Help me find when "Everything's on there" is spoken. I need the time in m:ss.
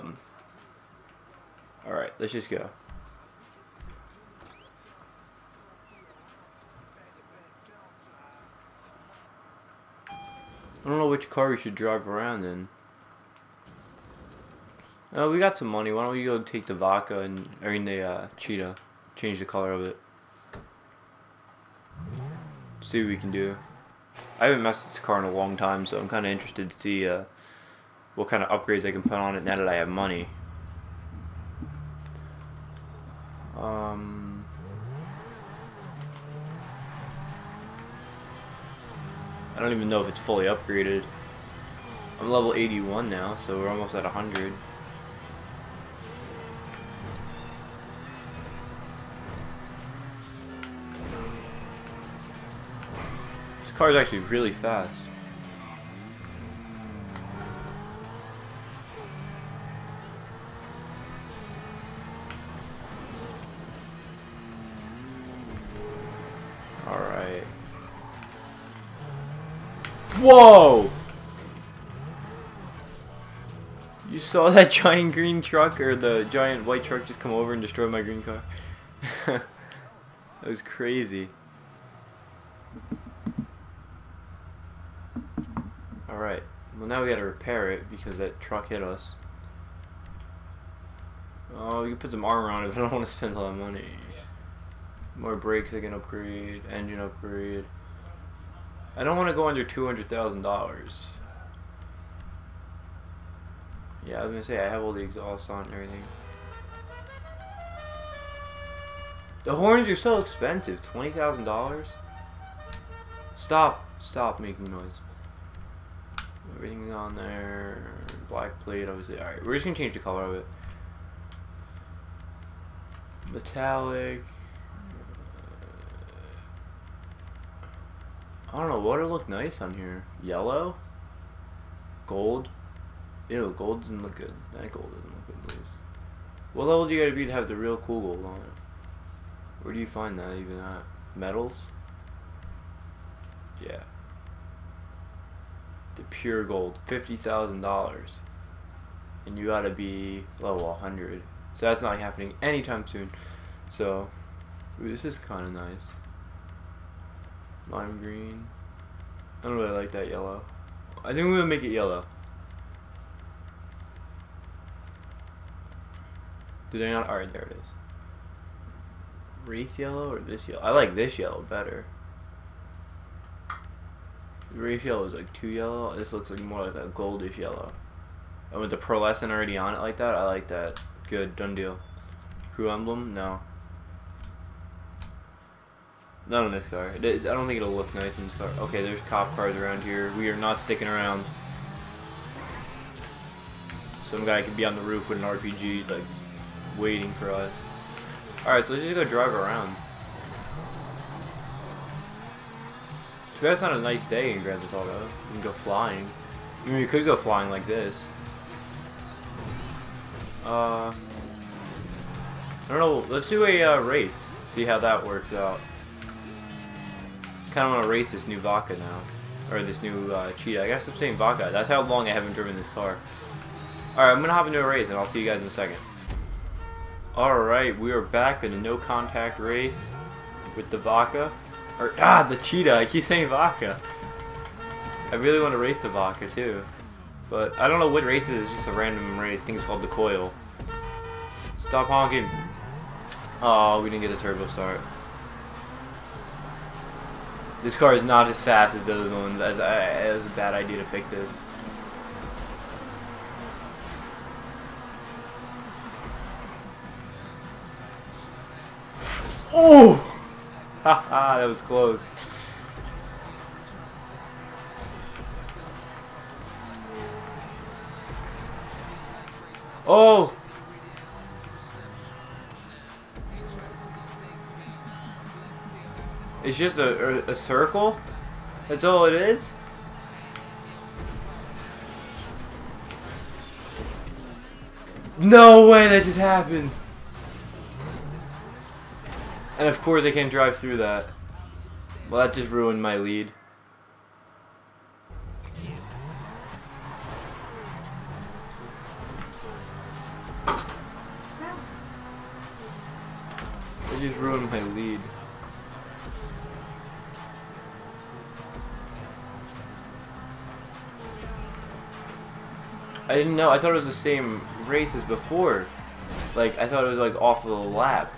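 1:56.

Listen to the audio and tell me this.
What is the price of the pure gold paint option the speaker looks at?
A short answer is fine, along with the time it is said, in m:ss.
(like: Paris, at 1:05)
$50,000, at 2:26.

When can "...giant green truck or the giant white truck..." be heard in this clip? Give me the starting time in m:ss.
1:14.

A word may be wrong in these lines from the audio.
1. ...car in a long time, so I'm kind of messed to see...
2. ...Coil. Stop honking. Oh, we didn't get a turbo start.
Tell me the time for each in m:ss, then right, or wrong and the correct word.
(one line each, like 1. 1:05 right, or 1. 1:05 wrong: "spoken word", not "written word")
1. 0:25 wrong: "interested", not "messed"
2. 3:59 right.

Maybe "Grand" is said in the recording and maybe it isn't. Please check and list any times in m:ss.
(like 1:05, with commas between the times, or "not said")
3:24.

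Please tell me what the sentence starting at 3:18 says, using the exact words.
Alright, so let's just go drive around.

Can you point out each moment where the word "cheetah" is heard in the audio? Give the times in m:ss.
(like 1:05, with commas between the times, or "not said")
0:18, 3:40, 3:52.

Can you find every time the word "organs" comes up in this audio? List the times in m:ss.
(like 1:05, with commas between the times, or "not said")
not said.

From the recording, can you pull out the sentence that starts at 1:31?
Oh, you can put some armor on it, but I don't want to spend a lot of money.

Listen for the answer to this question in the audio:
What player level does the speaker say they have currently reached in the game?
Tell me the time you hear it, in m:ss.
0:42.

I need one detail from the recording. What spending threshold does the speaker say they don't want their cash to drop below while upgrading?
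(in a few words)
$200,000.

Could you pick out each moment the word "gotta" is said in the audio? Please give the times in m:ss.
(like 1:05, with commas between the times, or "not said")
1:27, 2:17, 2:29.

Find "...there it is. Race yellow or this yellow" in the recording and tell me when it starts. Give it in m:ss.
2:47.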